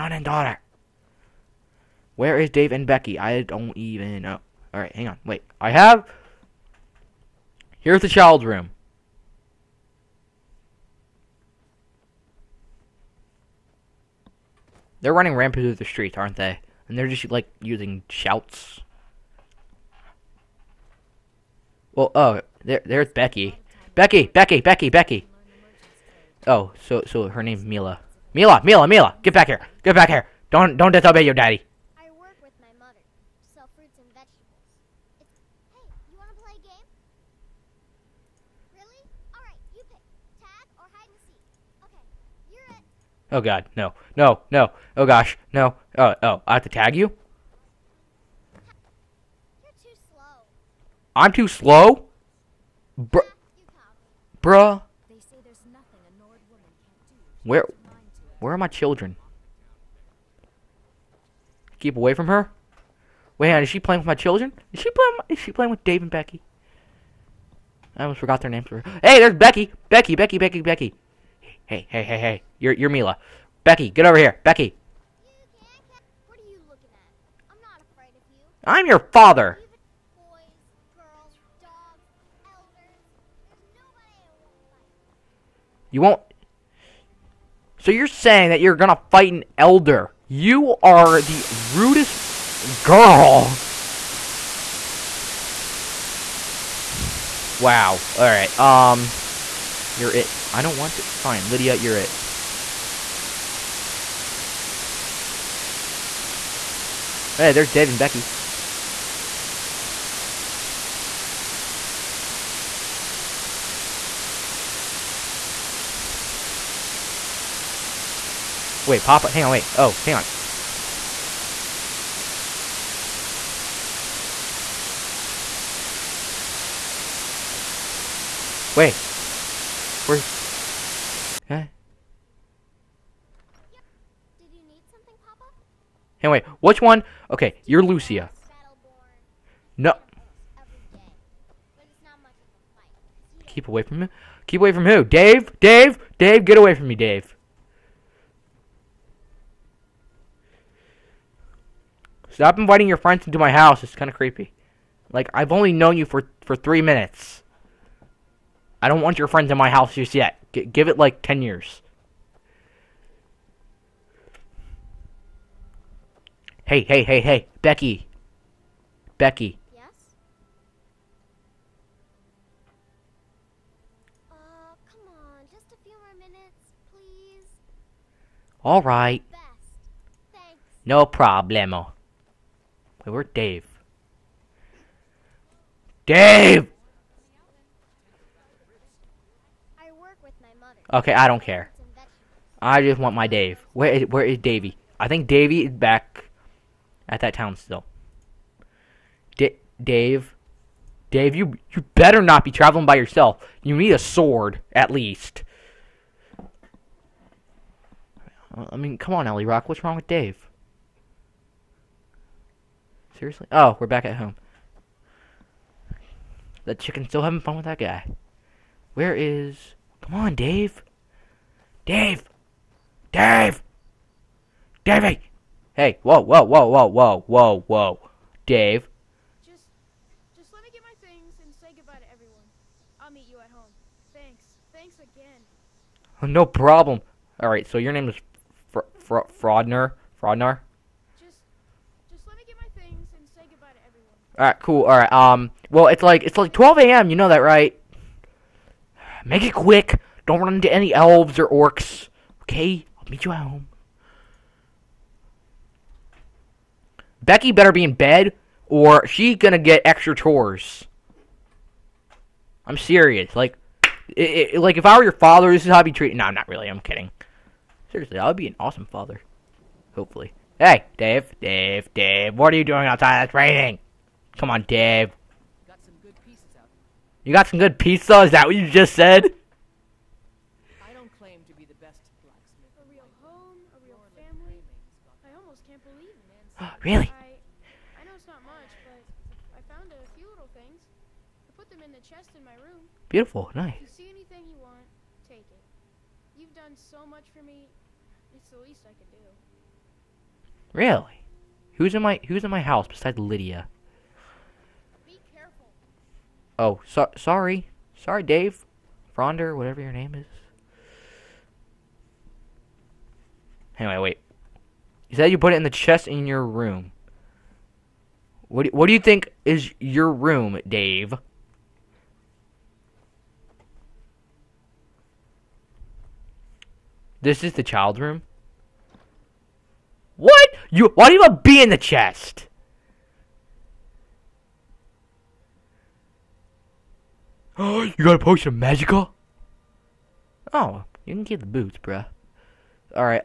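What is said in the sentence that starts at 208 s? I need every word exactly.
I mean, come on, Ellie Rock.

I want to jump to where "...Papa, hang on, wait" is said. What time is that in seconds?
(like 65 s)
119 s.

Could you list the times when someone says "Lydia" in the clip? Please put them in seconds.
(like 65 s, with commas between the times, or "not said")
101 s, 303 s.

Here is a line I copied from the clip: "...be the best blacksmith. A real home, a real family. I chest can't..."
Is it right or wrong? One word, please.
wrong.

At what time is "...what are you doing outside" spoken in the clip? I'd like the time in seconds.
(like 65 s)
272 s.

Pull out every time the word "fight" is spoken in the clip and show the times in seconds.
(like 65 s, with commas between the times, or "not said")
89 s.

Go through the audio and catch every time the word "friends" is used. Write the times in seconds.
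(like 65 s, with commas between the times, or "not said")
152 s, 159 s.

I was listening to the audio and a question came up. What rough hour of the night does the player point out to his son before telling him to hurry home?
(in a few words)
12 a.m.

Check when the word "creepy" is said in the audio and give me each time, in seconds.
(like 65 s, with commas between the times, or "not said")
154 s.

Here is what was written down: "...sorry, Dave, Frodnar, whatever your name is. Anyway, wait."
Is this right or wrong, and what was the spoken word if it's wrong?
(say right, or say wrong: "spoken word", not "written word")
right.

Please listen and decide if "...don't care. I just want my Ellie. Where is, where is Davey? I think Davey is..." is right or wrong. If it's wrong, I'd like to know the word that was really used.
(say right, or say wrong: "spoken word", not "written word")
wrong: "Dave", not "Ellie".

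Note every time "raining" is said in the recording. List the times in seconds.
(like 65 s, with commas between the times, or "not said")
273 s.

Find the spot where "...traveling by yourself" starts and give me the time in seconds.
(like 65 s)
202 s.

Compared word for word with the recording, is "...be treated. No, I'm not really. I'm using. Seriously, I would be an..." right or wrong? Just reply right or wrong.
wrong.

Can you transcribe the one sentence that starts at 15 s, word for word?
They're running rampant through the streets, aren't they?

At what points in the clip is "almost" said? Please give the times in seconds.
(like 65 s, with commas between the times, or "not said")
68 s, 285 s.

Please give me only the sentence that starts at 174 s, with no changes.
Uh, come on, just a few more minutes, please.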